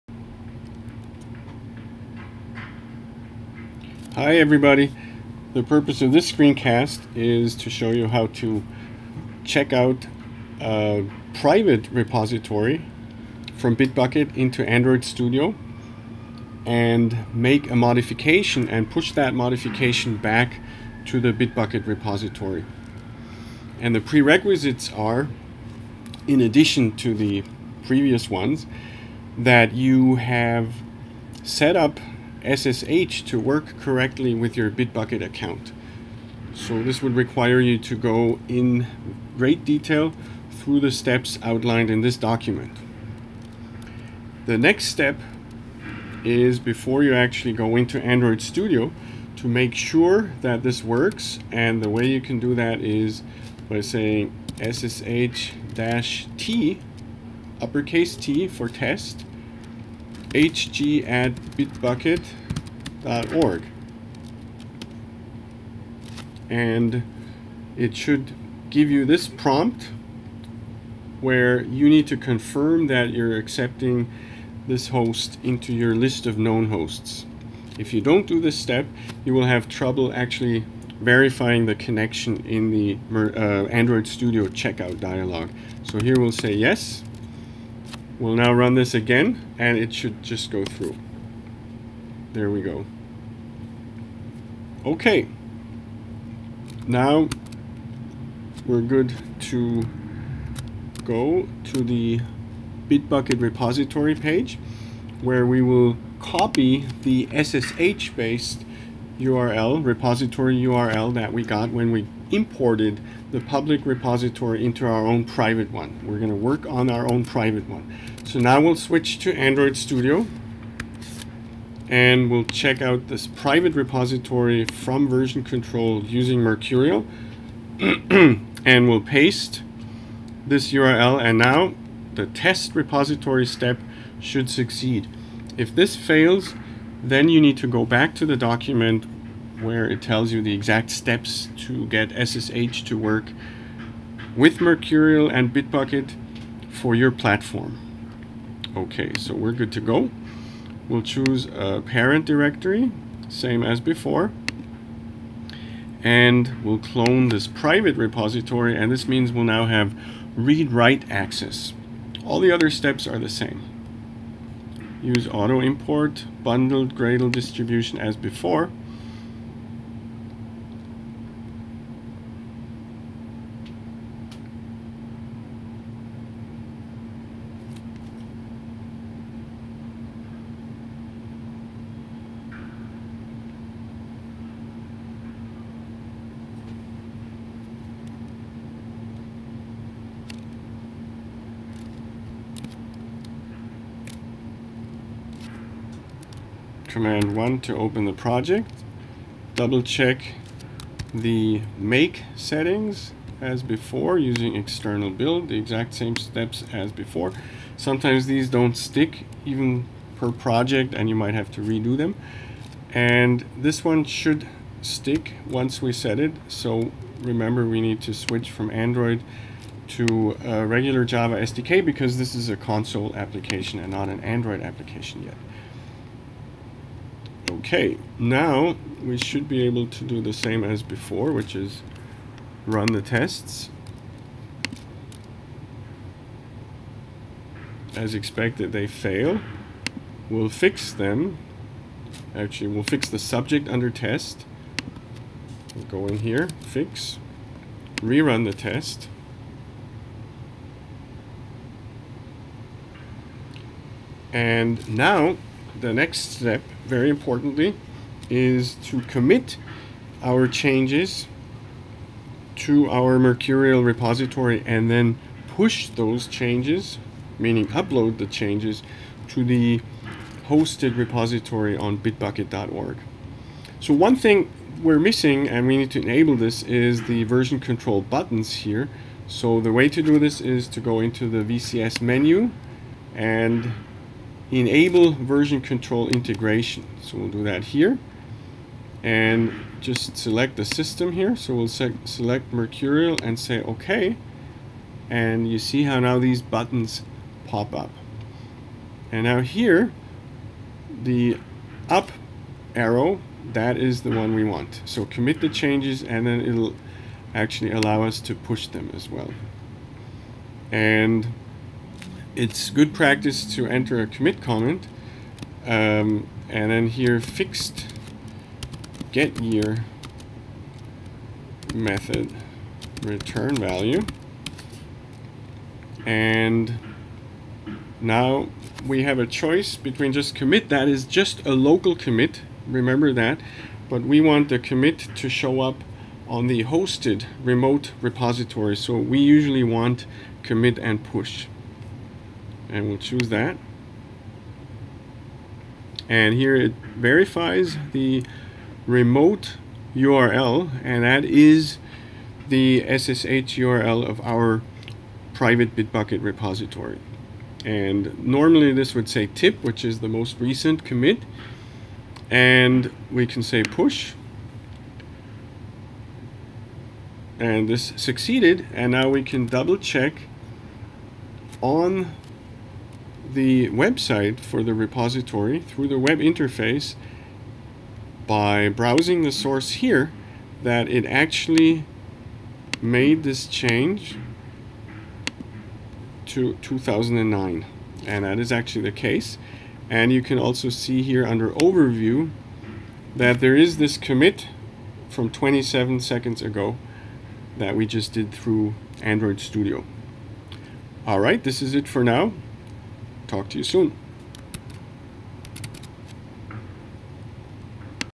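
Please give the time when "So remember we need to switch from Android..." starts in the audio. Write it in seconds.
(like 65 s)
216 s.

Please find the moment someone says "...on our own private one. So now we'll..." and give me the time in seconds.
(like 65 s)
116 s.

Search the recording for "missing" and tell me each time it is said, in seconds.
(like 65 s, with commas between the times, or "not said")
274 s.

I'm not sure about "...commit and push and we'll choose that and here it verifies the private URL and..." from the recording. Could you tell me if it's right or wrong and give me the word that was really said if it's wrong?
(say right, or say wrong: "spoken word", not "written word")
wrong: "remote", not "private".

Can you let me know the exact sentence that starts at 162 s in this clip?
All the other steps are the same.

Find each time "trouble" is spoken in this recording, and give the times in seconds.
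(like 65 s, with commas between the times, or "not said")
79 s.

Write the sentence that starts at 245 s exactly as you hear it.
We'll go in here, fix, rerun the test.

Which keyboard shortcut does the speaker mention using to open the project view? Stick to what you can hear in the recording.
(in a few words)
Command 1.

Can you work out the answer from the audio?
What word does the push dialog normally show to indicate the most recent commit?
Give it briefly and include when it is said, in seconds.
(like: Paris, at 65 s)
tip, at 359 s.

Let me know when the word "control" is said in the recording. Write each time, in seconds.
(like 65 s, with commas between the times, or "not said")
125 s, 277 s, 285 s.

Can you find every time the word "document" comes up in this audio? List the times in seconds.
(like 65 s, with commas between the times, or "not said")
42 s, 138 s.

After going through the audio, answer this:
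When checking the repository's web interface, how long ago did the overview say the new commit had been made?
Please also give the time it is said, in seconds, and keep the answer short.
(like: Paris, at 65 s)
27 seconds, at 395 s.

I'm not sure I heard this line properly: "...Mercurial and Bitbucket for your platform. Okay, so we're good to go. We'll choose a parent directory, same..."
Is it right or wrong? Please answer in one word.
right.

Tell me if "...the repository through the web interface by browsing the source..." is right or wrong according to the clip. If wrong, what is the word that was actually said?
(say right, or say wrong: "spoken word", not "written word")
right.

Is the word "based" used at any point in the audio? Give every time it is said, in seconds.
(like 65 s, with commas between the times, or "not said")
108 s.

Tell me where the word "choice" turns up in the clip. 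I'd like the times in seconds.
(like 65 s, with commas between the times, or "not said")
329 s.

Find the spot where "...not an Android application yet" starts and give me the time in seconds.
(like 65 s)
223 s.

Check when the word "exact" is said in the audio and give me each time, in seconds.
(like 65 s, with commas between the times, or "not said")
140 s, 205 s.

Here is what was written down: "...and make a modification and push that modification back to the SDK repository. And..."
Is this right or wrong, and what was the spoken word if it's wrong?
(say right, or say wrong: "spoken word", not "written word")
wrong: "Bitbucket", not "SDK".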